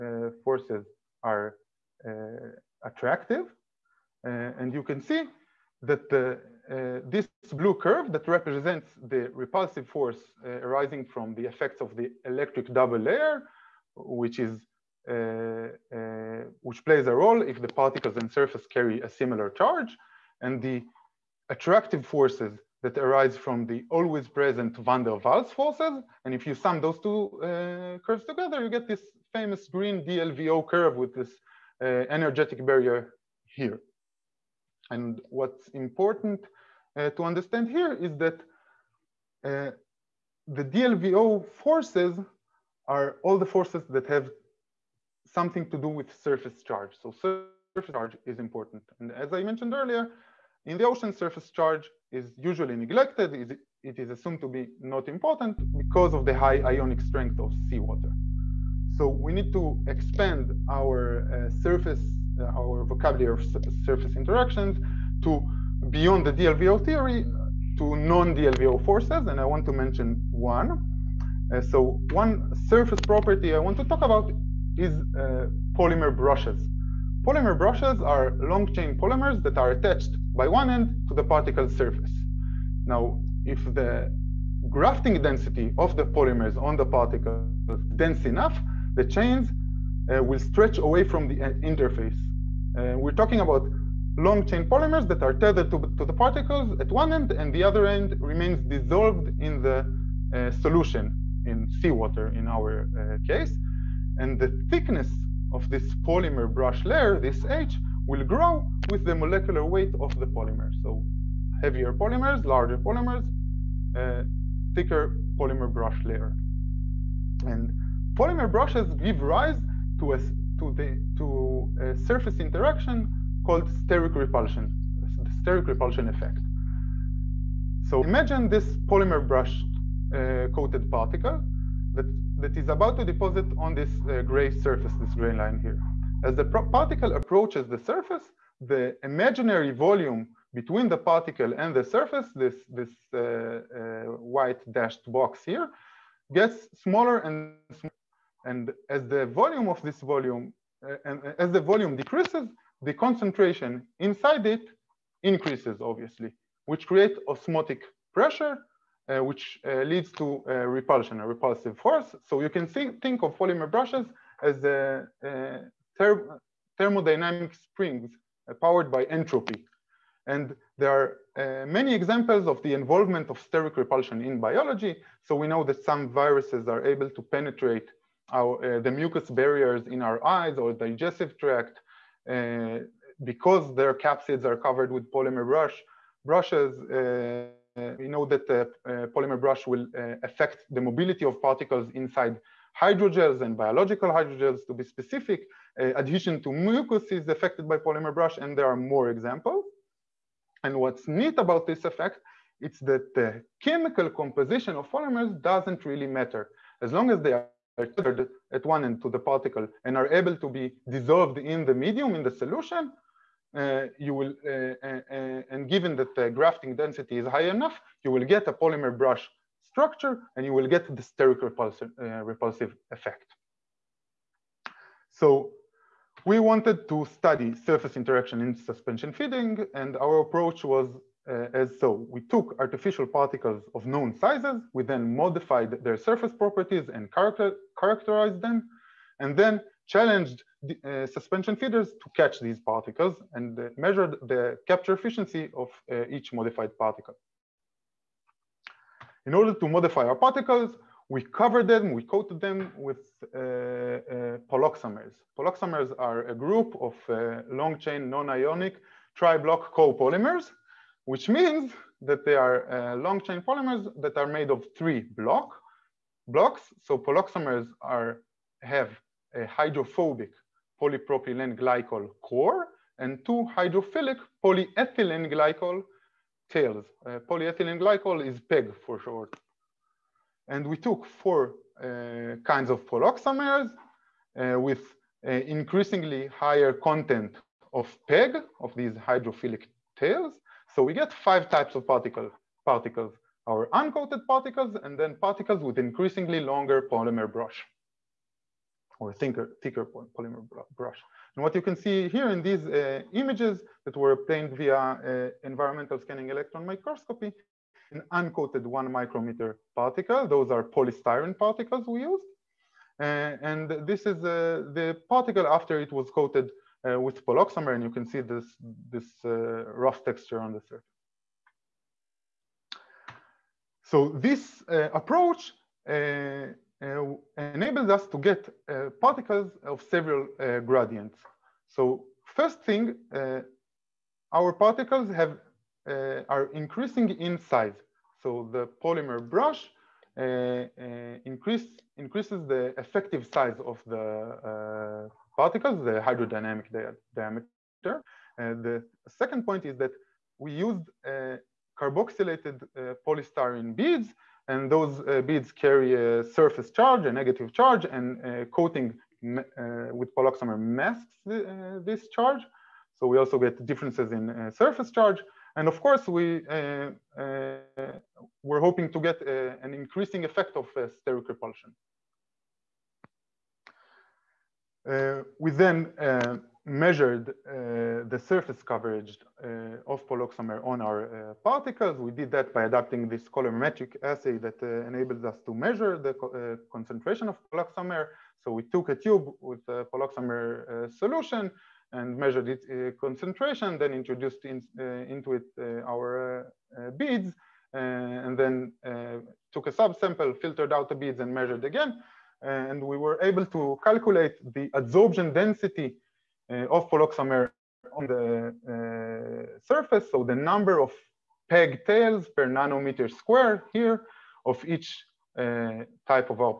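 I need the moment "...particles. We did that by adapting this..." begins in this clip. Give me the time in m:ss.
6:21.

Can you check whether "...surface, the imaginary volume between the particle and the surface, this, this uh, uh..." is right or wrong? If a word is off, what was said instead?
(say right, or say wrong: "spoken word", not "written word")
right.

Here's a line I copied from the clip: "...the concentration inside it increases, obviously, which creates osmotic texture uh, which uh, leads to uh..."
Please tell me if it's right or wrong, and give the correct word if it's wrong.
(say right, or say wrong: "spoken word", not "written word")
wrong: "pressure", not "texture".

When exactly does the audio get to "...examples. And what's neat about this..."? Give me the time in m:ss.
3:19.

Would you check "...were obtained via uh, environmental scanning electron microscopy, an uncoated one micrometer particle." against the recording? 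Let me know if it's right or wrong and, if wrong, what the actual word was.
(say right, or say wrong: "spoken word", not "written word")
right.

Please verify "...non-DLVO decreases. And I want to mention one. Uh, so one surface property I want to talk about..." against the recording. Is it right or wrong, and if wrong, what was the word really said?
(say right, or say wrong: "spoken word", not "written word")
wrong: "forces", not "decreases".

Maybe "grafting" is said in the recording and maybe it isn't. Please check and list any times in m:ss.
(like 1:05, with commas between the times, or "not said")
1:24, 3:36.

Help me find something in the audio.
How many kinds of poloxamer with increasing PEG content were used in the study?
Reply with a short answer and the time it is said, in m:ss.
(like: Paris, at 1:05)
4, at 4:41.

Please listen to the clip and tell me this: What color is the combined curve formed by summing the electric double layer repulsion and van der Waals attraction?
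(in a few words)
Green.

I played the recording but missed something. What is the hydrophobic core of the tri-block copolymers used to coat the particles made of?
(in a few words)
Polypropylene glycol.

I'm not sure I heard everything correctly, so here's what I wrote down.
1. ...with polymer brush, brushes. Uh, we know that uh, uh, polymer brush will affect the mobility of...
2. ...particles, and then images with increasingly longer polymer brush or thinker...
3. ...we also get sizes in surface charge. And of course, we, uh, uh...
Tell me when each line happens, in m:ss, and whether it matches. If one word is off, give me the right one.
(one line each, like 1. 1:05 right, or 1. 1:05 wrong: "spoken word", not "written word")
1. 3:04 right
2. 4:54 wrong: "particles", not "images"
3. 6:03 wrong: "differences", not "sizes".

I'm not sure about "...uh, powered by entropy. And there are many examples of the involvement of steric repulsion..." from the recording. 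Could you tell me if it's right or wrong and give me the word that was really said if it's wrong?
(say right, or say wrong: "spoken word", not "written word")
right.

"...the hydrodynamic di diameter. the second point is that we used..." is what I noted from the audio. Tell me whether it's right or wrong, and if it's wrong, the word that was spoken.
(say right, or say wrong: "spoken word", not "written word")
right.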